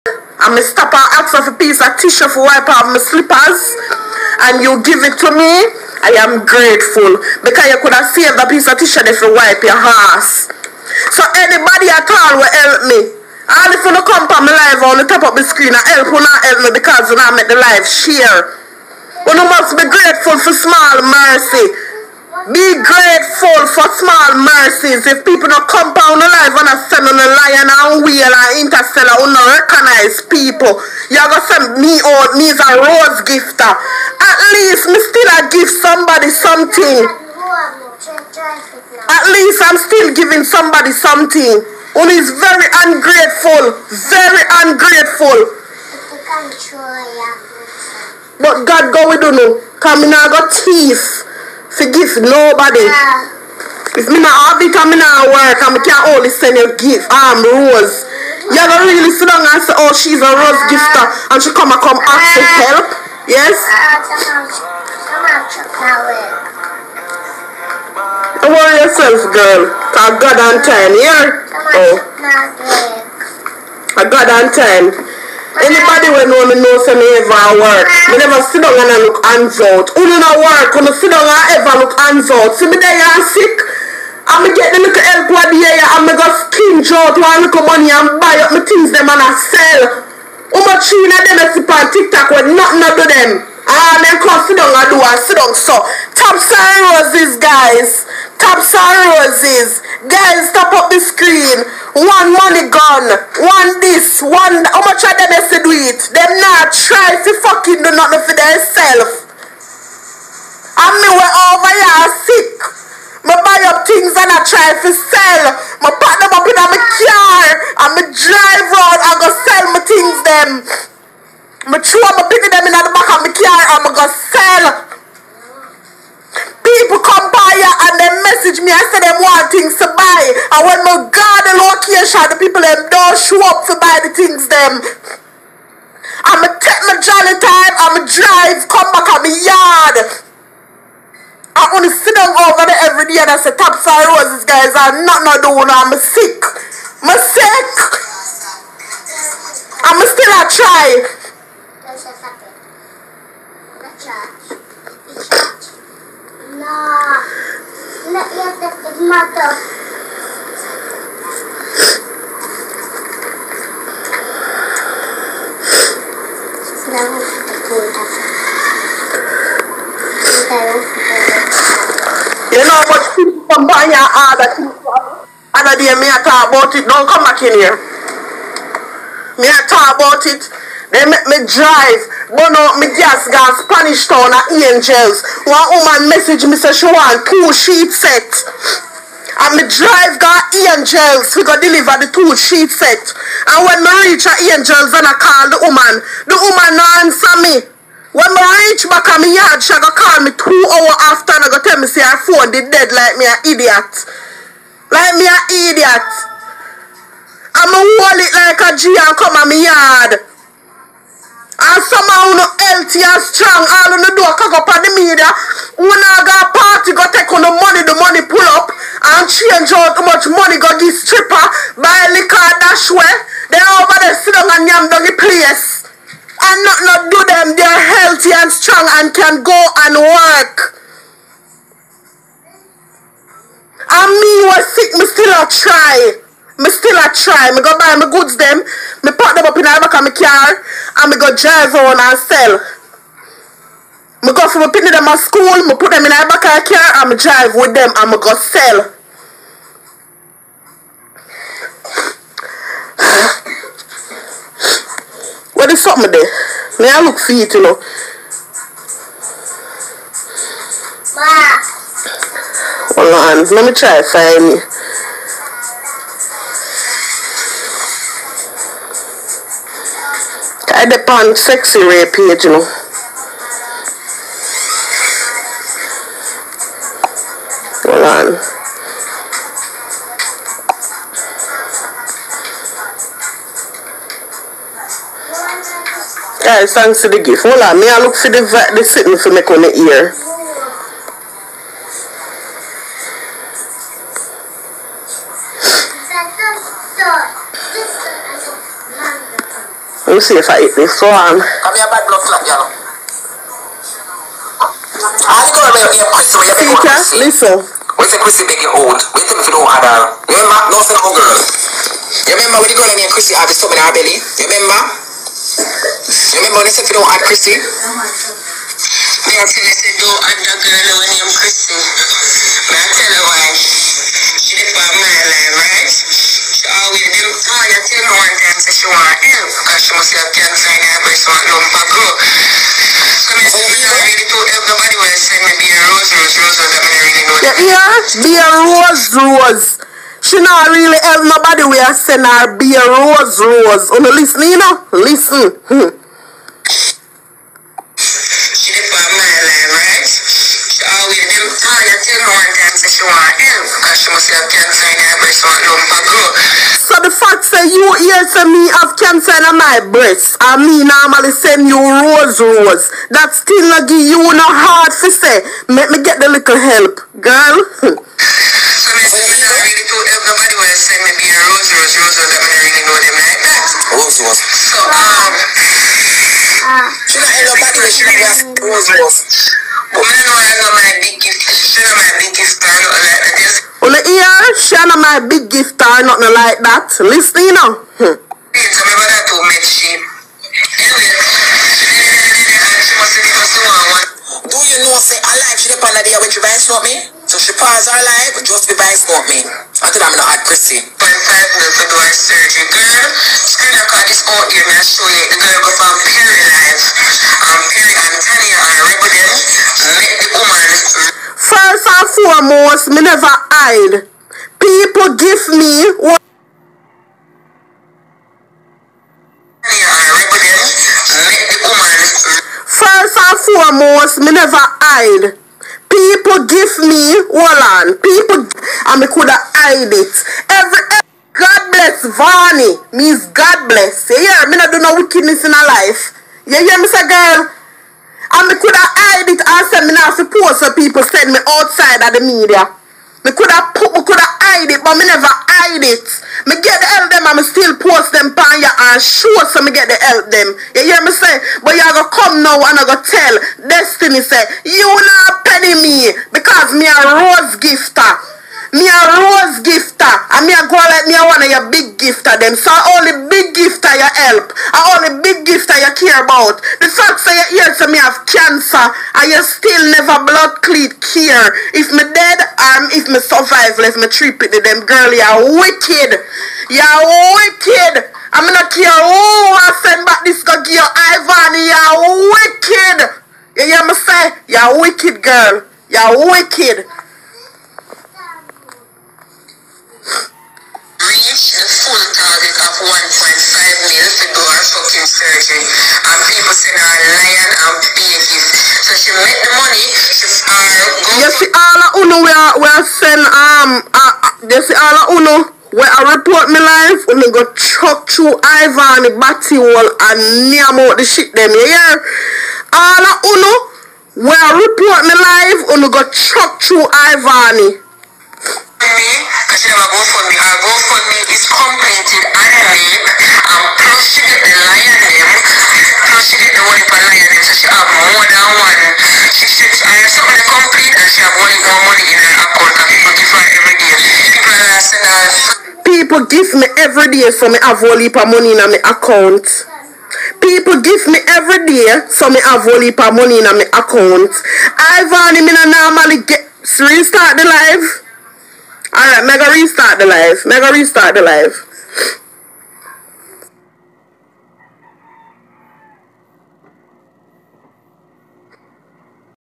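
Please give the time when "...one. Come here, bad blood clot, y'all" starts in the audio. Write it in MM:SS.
05:00.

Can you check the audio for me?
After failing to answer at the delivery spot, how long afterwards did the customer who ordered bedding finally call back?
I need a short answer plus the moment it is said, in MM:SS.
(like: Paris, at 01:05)
2 hours, at 03:20.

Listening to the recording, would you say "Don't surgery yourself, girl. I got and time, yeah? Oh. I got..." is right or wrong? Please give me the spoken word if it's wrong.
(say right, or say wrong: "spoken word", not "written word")
wrong: "worry", not "surgery".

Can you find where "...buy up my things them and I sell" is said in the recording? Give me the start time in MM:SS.
01:28.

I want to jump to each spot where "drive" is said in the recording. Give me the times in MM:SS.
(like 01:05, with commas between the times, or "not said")
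01:58, 02:18, 03:01, 03:09, 04:01, 04:07.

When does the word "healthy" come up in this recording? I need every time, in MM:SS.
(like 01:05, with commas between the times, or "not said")
03:32, 03:48.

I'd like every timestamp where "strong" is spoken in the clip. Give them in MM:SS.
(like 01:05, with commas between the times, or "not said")
03:33, 03:48.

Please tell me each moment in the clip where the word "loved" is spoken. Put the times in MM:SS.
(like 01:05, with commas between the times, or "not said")
not said.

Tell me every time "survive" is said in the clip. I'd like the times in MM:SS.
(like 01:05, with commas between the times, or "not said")
07:53.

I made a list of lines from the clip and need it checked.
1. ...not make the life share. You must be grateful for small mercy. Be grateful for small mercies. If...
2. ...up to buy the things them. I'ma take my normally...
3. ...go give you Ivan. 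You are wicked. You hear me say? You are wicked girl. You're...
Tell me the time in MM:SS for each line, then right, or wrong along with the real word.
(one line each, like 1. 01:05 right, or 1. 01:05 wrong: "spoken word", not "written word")
1. 00:17 right
2. 02:13 wrong: "jolly", not "normally"
3. 08:00 right.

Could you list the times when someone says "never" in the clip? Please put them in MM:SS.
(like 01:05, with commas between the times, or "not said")
01:18, 06:53, 07:04, 07:25, 07:49.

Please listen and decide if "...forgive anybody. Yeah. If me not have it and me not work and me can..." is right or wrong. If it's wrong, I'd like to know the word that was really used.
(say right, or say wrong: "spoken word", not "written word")
wrong: "nobody", not "anybody".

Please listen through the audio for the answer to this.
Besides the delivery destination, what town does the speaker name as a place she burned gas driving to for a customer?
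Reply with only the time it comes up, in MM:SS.
03:03.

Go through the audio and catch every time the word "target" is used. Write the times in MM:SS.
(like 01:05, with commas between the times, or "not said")
08:12.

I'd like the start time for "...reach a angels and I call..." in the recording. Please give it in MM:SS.
03:14.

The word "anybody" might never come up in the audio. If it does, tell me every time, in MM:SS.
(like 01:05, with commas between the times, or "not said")
00:11, 01:15.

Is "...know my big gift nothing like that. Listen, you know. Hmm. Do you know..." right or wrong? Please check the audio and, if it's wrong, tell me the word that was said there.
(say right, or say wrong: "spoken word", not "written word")
right.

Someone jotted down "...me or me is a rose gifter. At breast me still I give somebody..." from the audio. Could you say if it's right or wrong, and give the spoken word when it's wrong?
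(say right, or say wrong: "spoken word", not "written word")
wrong: "least", not "breast".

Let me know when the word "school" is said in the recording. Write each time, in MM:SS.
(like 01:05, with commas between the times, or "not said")
04:05.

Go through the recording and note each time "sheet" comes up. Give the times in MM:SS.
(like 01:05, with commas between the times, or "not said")
03:07, 03:12.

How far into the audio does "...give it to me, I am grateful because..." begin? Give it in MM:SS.
00:04.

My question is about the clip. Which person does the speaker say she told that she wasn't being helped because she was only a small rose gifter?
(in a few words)
Destiny.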